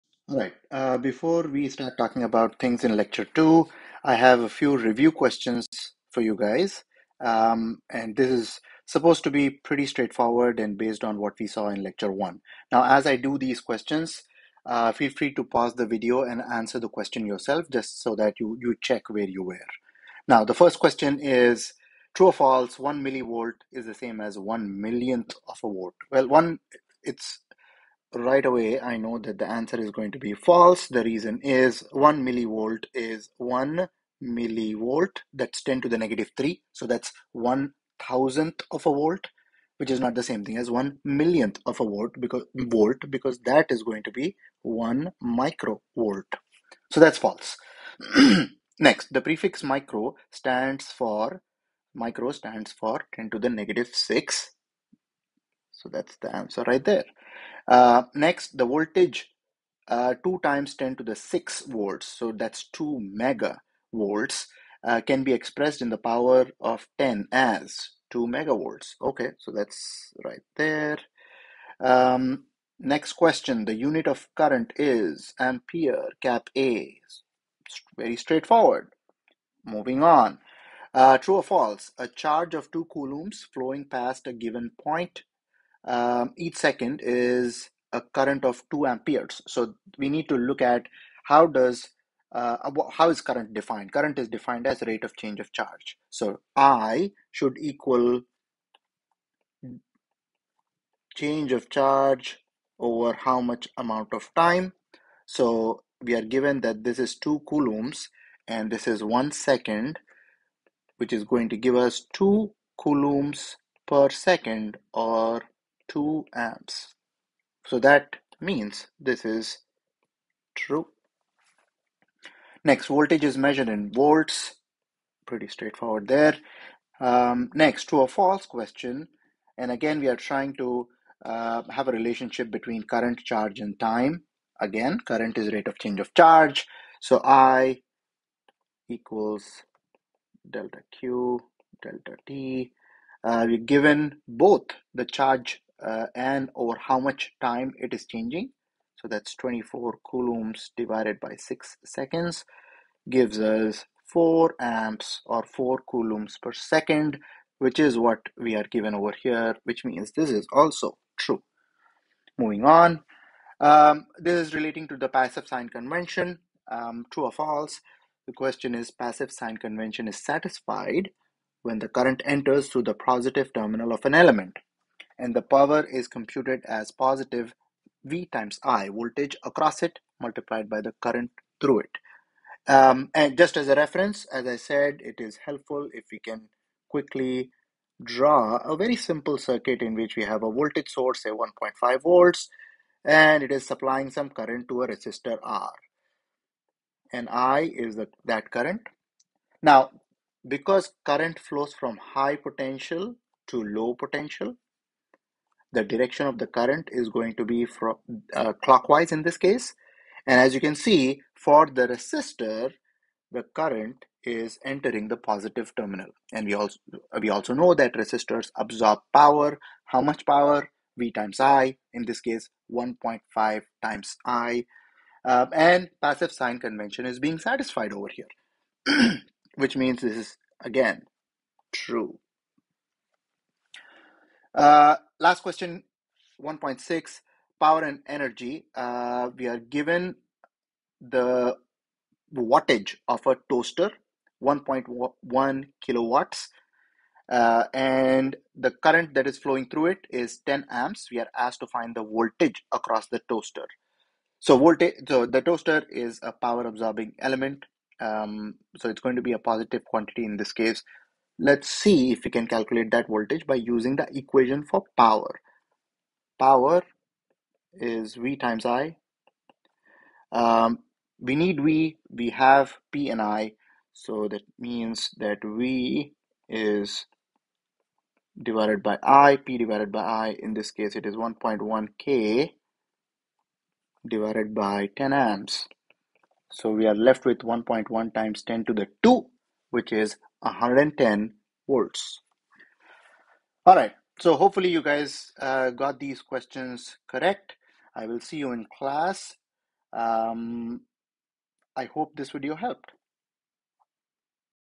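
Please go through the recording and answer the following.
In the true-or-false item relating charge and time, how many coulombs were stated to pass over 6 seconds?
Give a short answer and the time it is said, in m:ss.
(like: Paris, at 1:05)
24 coulombs, at 2:29.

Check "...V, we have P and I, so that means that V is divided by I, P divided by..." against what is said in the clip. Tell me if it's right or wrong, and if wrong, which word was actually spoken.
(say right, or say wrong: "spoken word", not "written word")
right.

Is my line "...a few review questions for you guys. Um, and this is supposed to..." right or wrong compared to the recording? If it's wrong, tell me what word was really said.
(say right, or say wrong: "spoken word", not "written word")
right.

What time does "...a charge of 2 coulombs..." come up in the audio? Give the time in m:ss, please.
1:21.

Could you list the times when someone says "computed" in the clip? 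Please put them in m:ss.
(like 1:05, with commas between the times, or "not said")
2:56.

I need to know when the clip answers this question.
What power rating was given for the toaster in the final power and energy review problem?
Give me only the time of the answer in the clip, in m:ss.
4:04.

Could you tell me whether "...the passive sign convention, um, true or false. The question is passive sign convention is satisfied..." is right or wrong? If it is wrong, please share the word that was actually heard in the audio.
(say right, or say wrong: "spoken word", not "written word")
right.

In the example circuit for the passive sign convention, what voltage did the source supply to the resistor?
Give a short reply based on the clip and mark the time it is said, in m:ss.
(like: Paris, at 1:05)
1.5 volts, at 3:11.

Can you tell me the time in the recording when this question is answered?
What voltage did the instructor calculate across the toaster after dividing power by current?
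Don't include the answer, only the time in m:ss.
4:50.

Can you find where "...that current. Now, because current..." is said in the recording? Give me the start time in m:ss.
3:18.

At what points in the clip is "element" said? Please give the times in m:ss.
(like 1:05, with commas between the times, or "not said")
2:54, 4:17.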